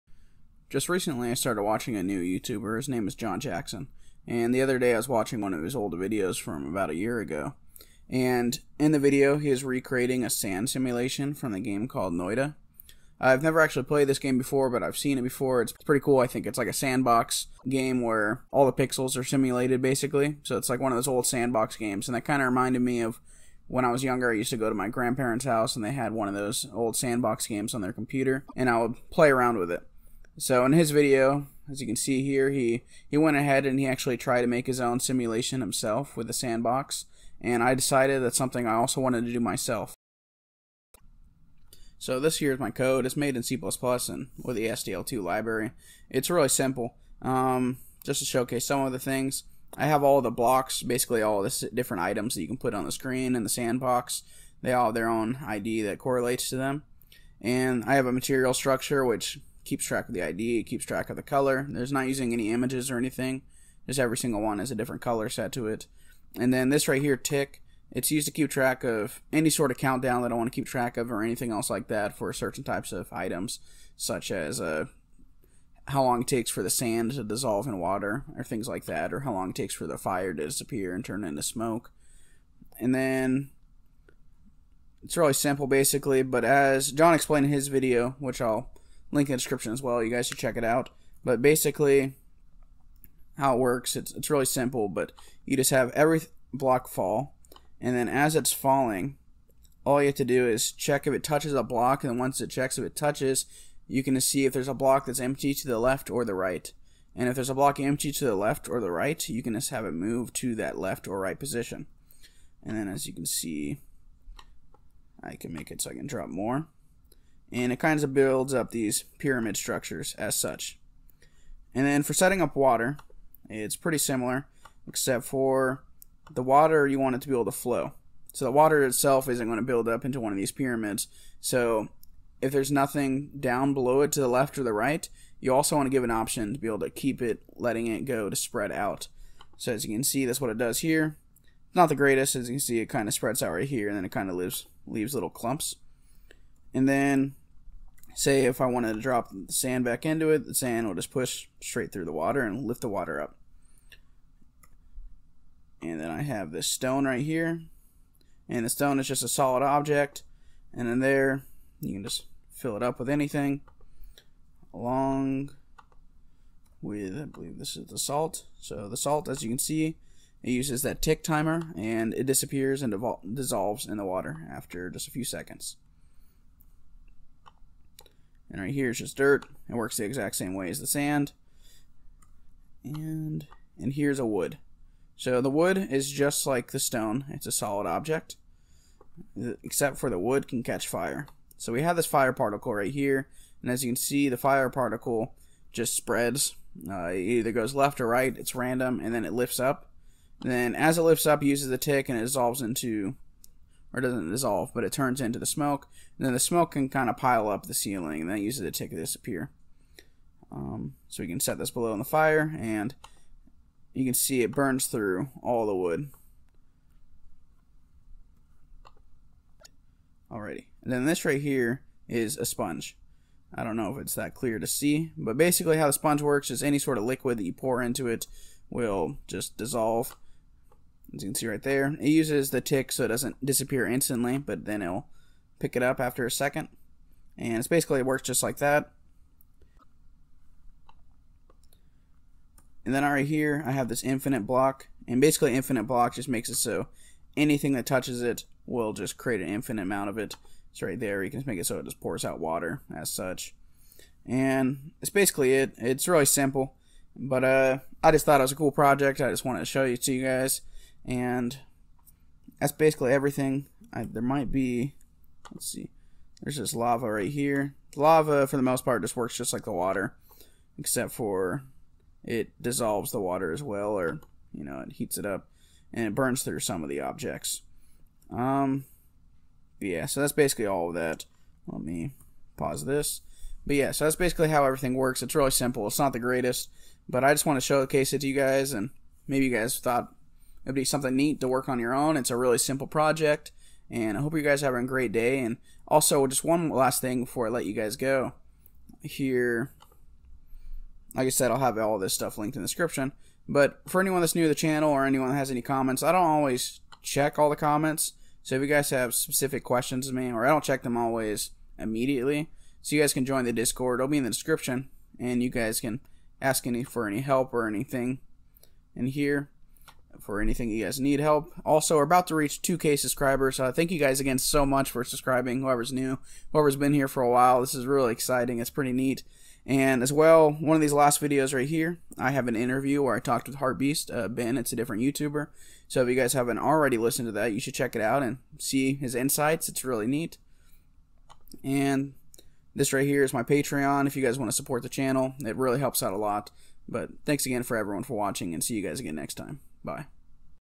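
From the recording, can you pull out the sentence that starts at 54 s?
They all have their own ID that correlates to them.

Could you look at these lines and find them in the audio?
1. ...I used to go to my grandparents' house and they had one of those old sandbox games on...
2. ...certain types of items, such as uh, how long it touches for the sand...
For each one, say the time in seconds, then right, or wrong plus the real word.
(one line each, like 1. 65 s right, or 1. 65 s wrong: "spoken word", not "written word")
1. 24 s right
2. 72 s wrong: "takes", not "touches".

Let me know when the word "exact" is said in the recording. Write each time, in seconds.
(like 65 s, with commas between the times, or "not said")
180 s.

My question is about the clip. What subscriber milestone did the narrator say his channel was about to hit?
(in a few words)
2K.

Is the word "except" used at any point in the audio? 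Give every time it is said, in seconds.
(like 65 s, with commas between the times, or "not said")
124 s, 189 s, 270 s.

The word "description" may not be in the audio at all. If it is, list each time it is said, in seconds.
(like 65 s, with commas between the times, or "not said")
89 s, 302 s, 314 s.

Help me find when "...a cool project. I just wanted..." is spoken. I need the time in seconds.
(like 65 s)
258 s.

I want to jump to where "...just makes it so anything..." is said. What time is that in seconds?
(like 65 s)
246 s.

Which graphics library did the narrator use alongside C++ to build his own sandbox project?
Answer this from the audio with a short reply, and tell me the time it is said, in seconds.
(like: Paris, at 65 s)
SDL 2, at 44 s.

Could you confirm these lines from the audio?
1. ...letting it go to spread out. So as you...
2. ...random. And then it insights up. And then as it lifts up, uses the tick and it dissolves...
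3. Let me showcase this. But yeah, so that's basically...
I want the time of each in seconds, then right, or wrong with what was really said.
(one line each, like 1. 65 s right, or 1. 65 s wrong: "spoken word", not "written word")
1. 137 s right
2. 198 s wrong: "lifts", not "insights"
3. 281 s wrong: "pause", not "showcase".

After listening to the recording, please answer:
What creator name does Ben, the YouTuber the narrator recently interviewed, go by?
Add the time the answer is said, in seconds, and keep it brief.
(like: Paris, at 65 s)
Heartbeast, at 333 s.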